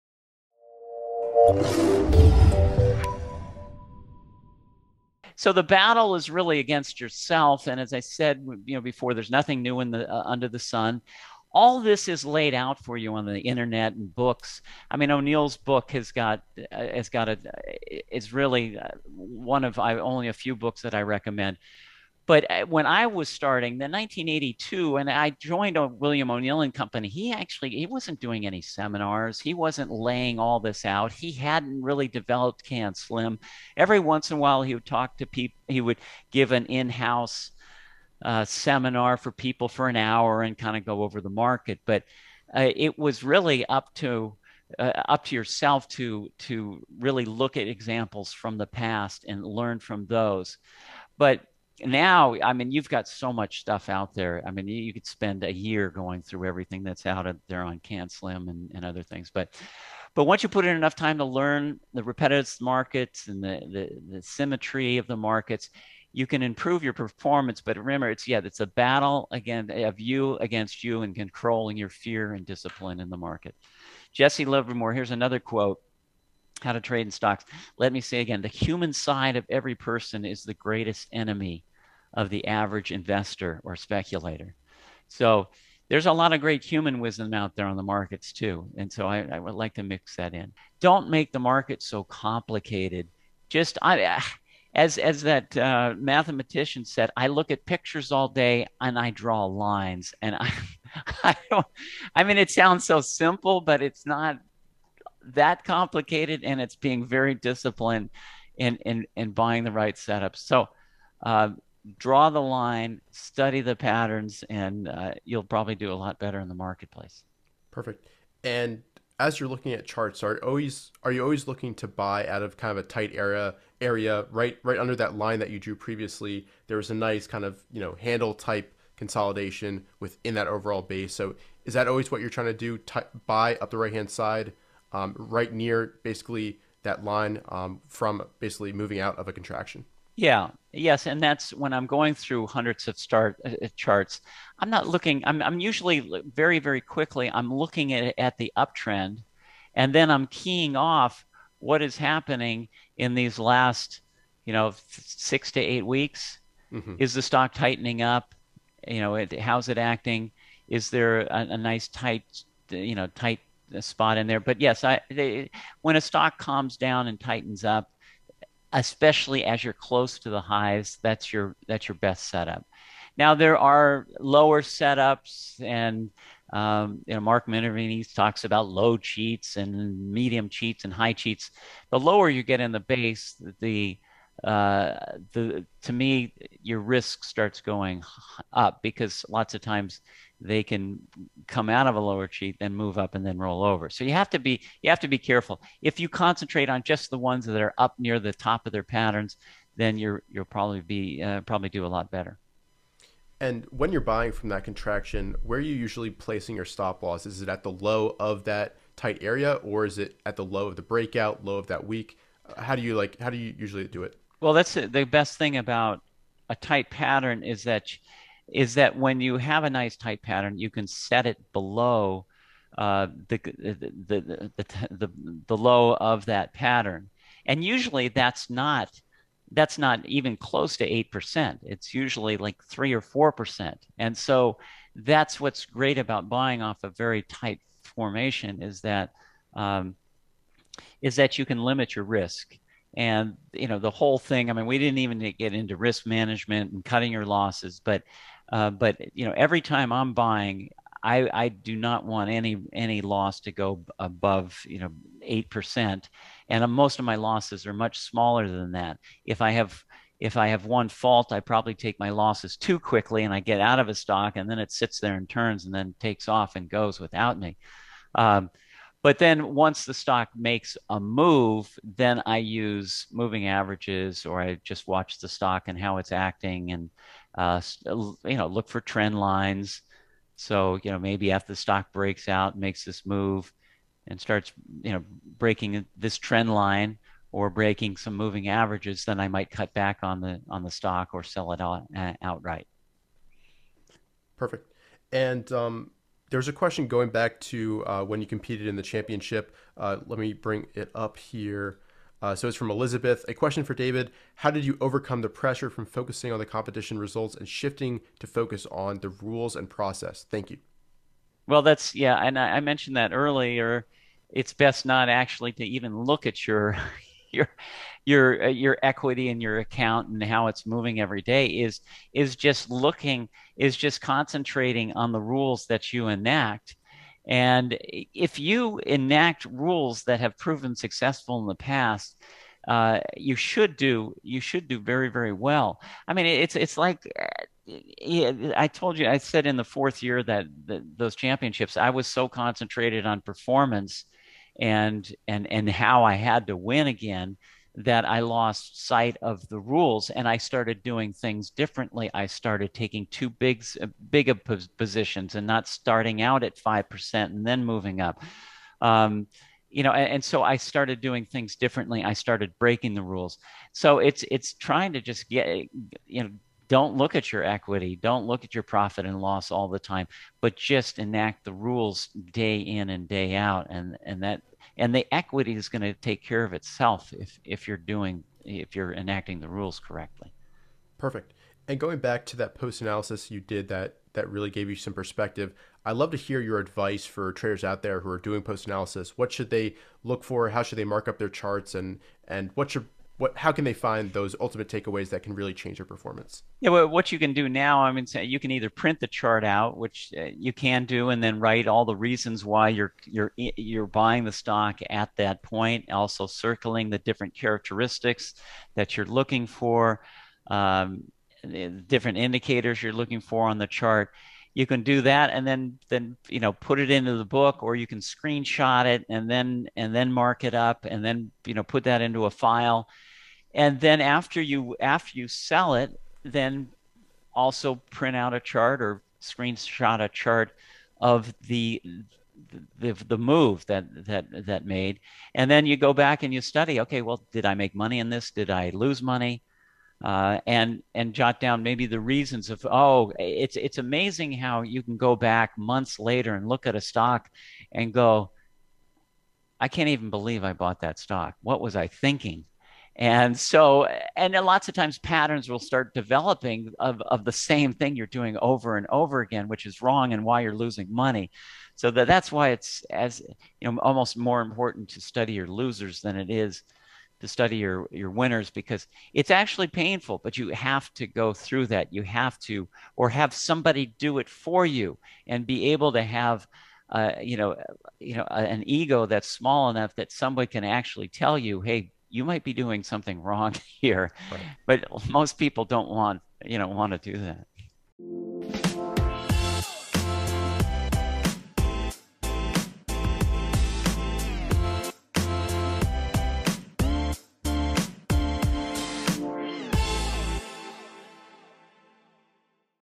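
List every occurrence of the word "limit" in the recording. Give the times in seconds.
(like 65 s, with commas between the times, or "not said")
241 s.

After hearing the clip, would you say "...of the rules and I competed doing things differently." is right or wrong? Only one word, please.
wrong.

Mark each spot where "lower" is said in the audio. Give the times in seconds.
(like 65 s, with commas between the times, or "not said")
174 s, 181 s, 191 s.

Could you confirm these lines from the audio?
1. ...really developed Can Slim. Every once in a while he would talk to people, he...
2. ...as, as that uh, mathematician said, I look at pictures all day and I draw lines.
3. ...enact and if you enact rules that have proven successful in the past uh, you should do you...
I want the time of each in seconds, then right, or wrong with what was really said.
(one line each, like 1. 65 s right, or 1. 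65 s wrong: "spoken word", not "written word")
1. 31 s right
2. 94 s right
3. 326 s right.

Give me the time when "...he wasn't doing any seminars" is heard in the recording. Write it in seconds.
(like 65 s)
27 s.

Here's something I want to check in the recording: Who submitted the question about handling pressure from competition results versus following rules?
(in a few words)
Elizabeth.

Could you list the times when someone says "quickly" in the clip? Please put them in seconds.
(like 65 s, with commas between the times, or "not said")
146 s, 262 s.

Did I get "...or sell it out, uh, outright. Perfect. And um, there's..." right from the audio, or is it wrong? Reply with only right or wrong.
right.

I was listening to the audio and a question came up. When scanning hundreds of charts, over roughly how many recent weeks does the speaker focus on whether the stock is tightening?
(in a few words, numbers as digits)
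6 to 8 weeks.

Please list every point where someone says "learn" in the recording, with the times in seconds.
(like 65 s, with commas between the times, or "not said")
49 s, 61 s.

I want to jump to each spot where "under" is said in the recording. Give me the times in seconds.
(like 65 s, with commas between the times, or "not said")
10 s, 124 s.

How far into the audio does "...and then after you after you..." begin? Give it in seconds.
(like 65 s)
423 s.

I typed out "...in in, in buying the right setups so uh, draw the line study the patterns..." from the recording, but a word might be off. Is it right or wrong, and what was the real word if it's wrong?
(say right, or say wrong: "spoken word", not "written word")
right.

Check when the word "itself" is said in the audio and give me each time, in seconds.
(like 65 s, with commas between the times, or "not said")
376 s.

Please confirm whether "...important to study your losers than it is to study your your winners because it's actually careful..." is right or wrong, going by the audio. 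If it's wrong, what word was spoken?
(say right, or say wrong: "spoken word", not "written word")
wrong: "painful", not "careful".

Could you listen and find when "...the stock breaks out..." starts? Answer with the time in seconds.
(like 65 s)
281 s.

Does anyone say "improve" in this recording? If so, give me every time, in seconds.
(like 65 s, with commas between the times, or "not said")
66 s.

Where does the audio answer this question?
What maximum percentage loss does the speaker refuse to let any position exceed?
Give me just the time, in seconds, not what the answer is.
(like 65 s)
255 s.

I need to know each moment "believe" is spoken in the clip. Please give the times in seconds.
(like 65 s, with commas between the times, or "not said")
450 s.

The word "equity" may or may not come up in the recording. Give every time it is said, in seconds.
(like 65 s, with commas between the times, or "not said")
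318 s, 367 s, 375 s.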